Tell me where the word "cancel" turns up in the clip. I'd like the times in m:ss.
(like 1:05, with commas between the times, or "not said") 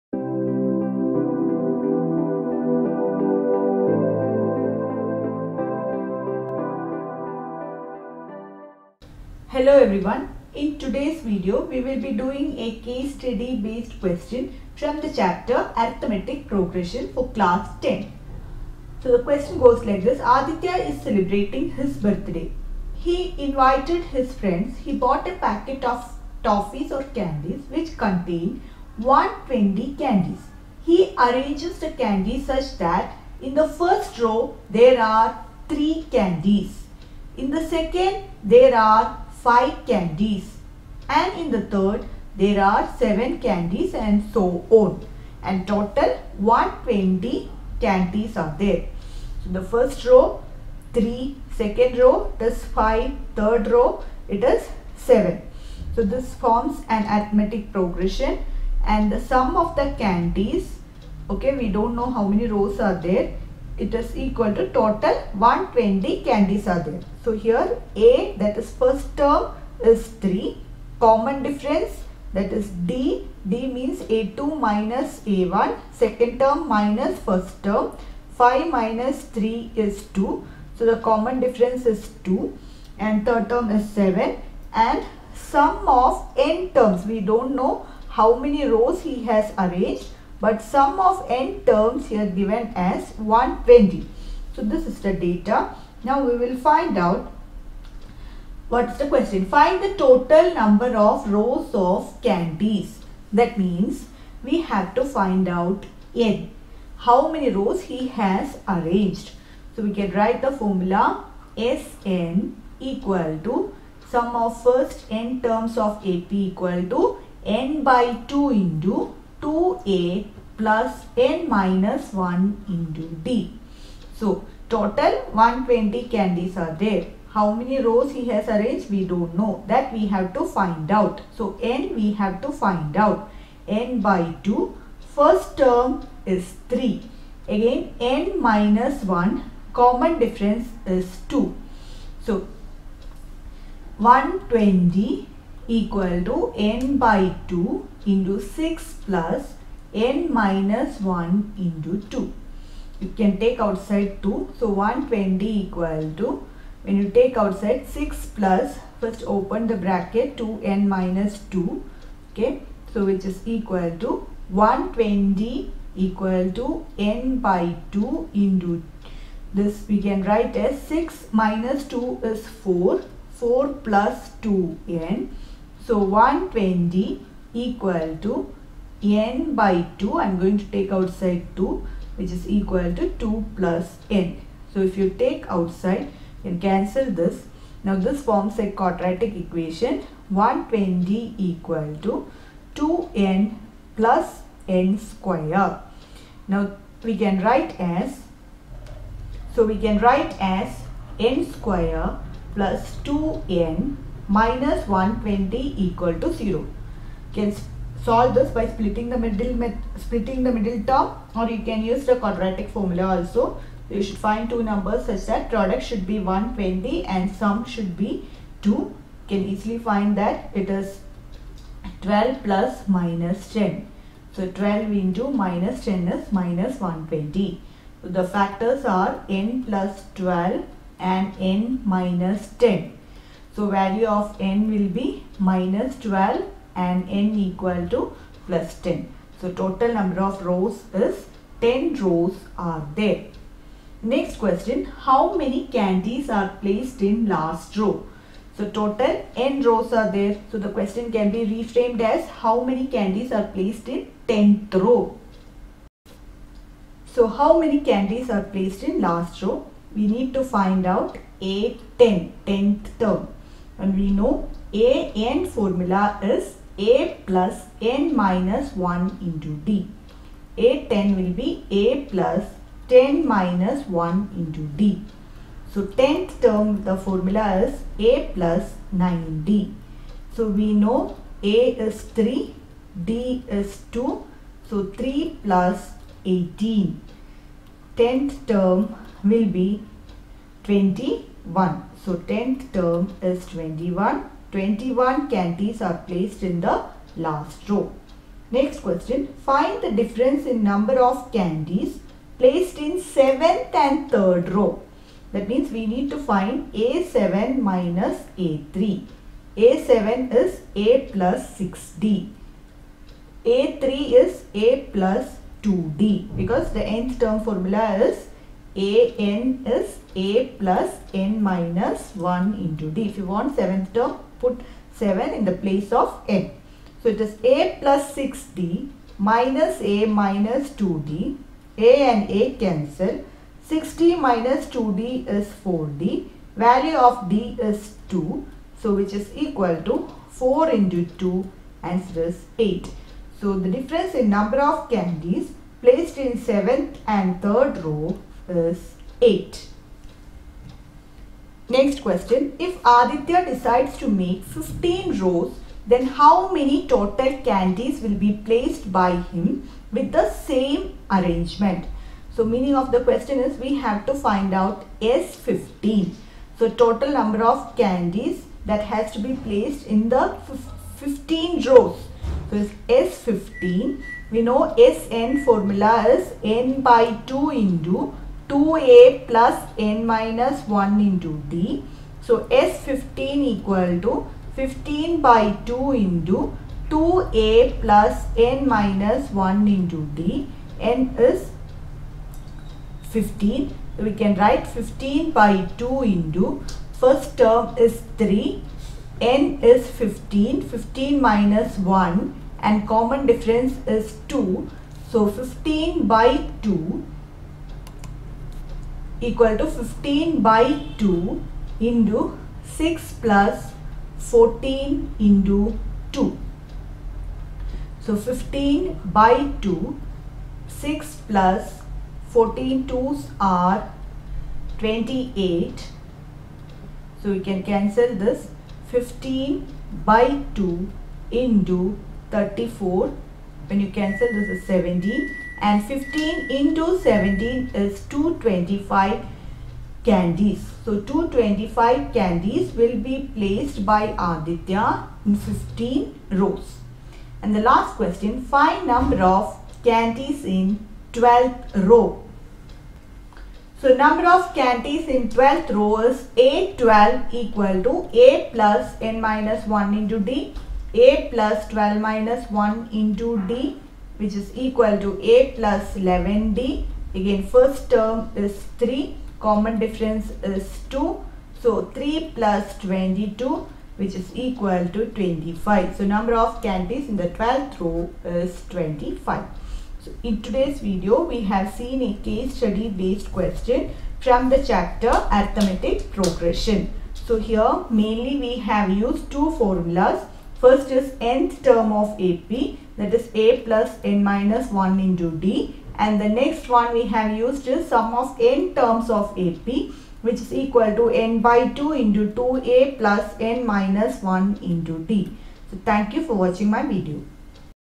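3:06, 5:32, 7:07, 7:13.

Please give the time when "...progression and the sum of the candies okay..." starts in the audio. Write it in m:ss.
0:57.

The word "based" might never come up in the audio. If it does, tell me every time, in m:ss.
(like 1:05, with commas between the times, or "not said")
0:13, 8:02.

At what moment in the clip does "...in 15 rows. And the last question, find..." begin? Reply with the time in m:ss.
7:25.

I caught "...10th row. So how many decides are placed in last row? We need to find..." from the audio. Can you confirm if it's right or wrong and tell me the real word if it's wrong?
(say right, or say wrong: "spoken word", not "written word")
wrong: "candies", not "decides".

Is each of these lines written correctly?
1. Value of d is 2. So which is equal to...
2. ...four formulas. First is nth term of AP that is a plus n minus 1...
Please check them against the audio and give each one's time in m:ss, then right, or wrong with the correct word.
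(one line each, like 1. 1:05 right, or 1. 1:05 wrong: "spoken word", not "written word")
1. 5:36 right
2. 8:09 wrong: "two", not "four".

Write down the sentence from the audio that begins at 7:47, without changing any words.
Again, first term is 3, common difference is 2.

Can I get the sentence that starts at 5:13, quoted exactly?
A3 is A plus 2D because the nth term formula is an is a plus n minus 1 into d.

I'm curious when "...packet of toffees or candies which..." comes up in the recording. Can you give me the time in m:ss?
0:25.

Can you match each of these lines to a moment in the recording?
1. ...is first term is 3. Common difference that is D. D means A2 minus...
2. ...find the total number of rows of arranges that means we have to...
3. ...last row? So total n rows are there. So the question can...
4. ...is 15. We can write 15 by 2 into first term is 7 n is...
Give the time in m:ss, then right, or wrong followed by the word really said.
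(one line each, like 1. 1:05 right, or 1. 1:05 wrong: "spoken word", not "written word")
1. 1:08 right
2. 1:39 wrong: "candies", not "arranges"
3. 4:07 right
4. 6:31 wrong: "3", not "7".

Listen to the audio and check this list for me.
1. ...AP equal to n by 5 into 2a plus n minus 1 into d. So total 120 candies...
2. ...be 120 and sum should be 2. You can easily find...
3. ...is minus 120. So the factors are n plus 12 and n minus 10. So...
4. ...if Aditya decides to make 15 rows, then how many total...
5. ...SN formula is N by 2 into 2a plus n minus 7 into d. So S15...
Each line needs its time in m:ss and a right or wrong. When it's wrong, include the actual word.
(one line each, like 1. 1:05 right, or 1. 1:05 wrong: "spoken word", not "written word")
1. 1:56 wrong: "2", not "5"
2. 3:36 right
3. 3:46 right
4. 5:52 right
5. 6:14 wrong: "1", not "7".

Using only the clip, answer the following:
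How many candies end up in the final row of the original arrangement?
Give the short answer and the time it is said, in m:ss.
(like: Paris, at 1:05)
21, at 4:54.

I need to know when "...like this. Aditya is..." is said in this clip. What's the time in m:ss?
0:19.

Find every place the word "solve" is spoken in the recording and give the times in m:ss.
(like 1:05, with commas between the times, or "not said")
3:28.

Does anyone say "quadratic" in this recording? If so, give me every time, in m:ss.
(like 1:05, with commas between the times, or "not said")
3:08, 3:32.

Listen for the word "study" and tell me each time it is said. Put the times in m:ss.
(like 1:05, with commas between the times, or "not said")
0:13, 8:02.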